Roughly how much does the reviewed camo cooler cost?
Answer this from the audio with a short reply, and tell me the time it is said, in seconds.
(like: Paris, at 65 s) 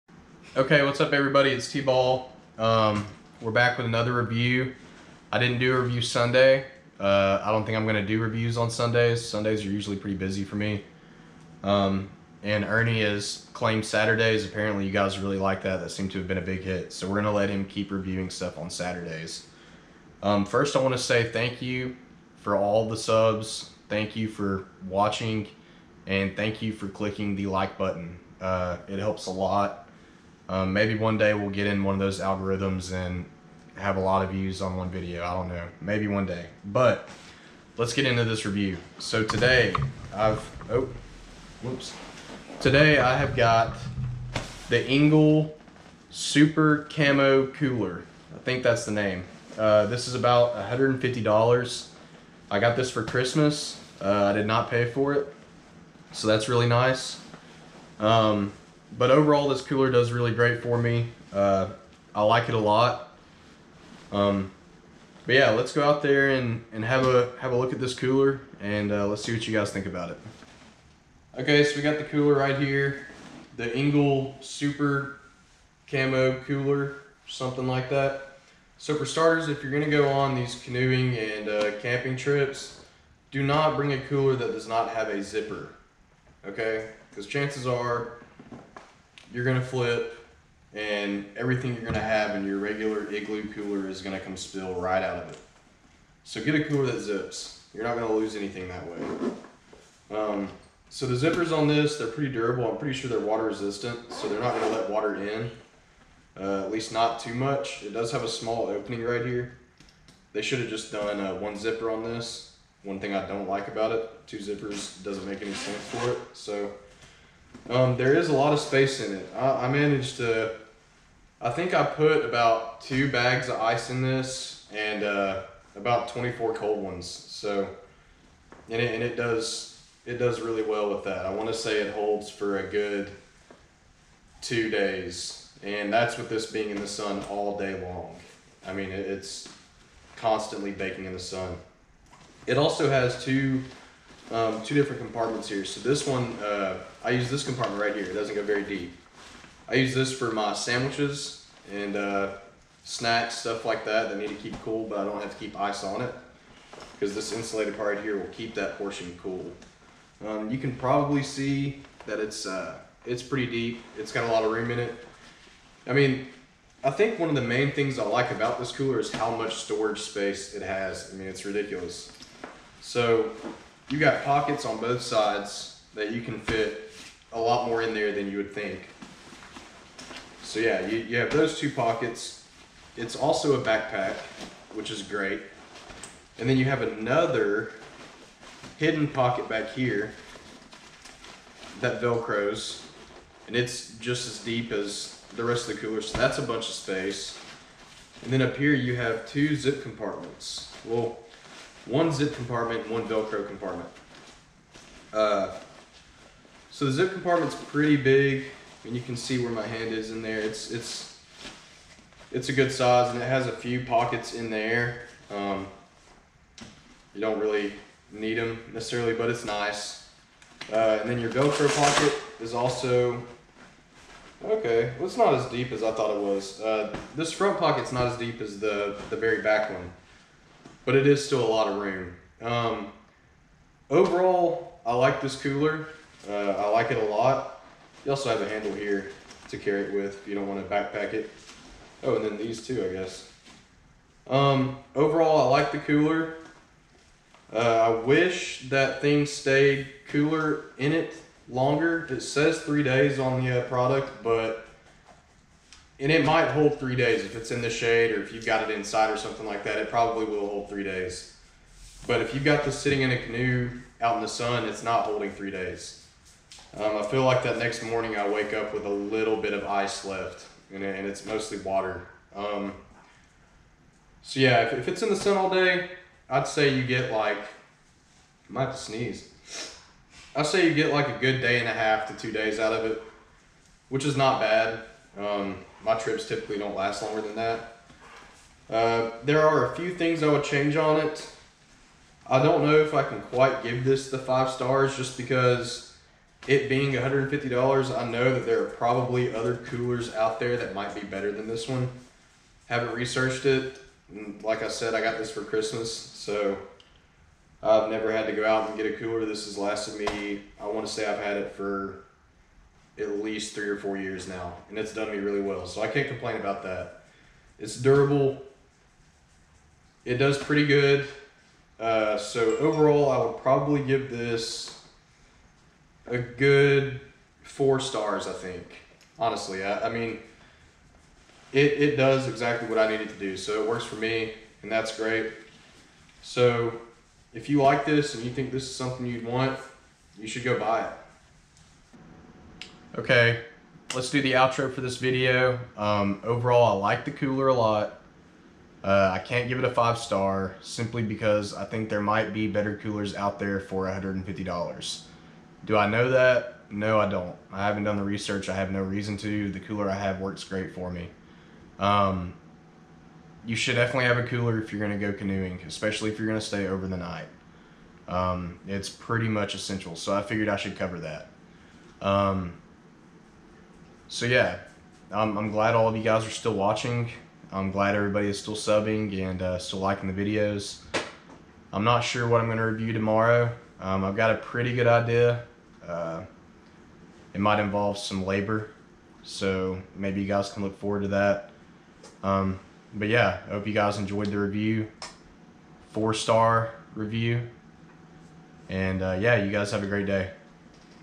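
$150, at 50 s.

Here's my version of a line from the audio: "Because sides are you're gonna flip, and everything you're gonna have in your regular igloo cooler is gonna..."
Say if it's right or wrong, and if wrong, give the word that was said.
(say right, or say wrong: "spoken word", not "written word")
wrong: "chances", not "sides".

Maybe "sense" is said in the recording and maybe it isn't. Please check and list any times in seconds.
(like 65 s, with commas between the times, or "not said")
115 s.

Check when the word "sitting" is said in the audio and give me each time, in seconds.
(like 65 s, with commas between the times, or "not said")
262 s.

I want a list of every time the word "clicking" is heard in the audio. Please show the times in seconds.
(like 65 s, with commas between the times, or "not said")
26 s.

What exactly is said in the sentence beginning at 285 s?
Um, my trips typically don't last longer than that.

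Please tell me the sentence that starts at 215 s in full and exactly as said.
Um, you don't really need them necessarily, but it's nice.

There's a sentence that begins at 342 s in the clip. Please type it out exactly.
Okay, let's do the outro for this video.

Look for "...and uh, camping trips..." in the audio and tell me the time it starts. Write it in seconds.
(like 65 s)
81 s.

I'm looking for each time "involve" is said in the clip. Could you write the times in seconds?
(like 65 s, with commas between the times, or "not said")
387 s.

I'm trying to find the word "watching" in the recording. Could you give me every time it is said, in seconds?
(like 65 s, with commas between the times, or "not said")
24 s, 376 s.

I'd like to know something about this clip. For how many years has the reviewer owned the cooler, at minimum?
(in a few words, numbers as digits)
3 or 4 years.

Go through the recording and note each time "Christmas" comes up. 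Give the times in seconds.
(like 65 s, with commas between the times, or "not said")
53 s, 305 s.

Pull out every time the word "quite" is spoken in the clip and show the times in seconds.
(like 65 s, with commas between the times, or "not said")
293 s.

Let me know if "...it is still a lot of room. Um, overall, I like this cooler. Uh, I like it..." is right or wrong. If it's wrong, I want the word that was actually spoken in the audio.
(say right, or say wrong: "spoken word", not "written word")
right.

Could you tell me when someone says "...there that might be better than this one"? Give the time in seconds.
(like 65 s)
300 s.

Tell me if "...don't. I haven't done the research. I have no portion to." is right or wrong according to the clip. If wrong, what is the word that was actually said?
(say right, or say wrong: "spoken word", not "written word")
wrong: "reason", not "portion".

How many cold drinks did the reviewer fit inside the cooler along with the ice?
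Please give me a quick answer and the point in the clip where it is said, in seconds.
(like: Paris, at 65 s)
24, at 125 s.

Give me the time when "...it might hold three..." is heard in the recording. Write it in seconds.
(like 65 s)
256 s.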